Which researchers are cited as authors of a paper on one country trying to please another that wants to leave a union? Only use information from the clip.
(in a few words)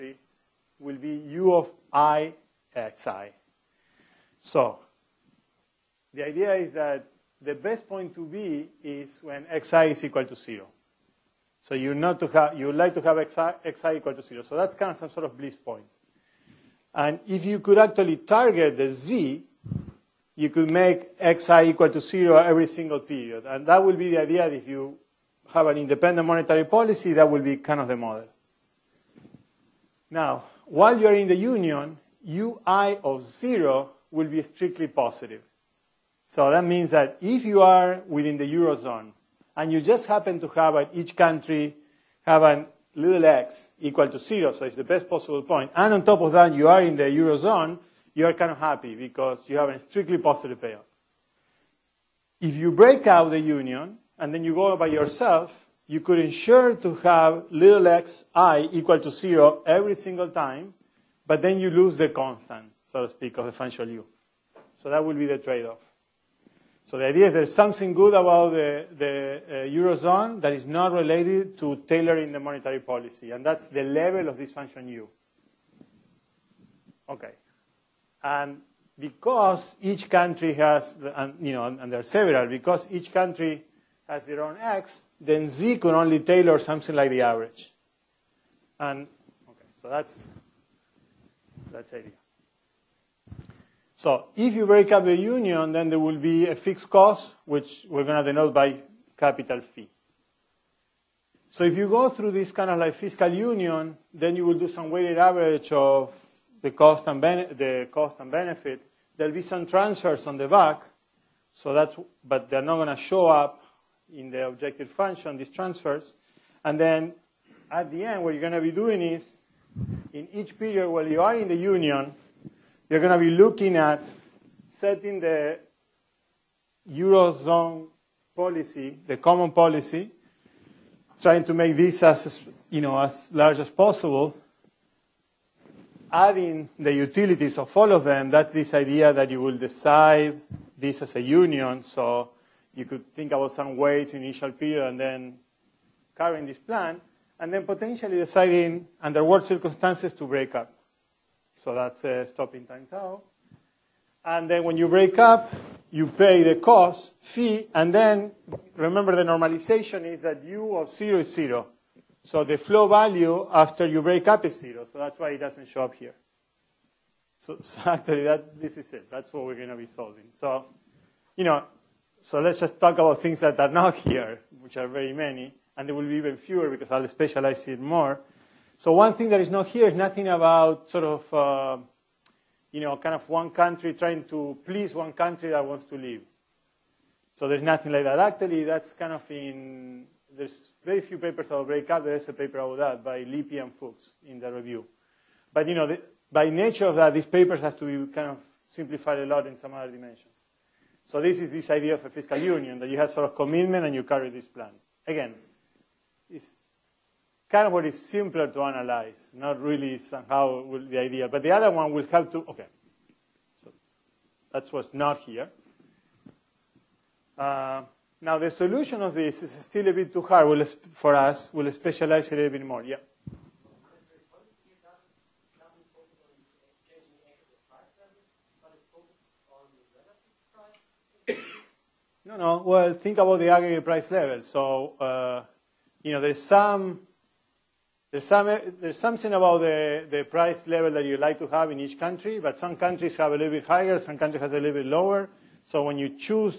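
Lippi and Fuchs.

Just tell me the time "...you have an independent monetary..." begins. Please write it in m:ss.
0:24.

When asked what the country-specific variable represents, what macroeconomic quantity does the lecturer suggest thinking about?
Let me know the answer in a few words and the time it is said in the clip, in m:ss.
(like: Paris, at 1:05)
aggregate price level, at 3:53.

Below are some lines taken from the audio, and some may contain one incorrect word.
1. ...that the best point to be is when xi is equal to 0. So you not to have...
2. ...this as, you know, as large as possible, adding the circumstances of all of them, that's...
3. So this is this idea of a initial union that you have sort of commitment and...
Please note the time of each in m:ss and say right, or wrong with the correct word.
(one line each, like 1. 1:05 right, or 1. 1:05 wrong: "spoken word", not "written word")
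1. 0:06 right
2. 2:11 wrong: "utilities", not "circumstances"
3. 3:21 wrong: "fiscal", not "initial".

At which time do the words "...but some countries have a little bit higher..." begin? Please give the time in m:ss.
4:02.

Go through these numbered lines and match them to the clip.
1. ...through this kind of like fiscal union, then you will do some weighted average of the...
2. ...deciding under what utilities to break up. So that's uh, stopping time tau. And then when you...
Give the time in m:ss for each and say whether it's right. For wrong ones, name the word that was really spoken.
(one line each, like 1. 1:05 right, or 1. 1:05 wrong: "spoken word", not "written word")
1. 1:42 right
2. 2:28 wrong: "circumstances", not "utilities".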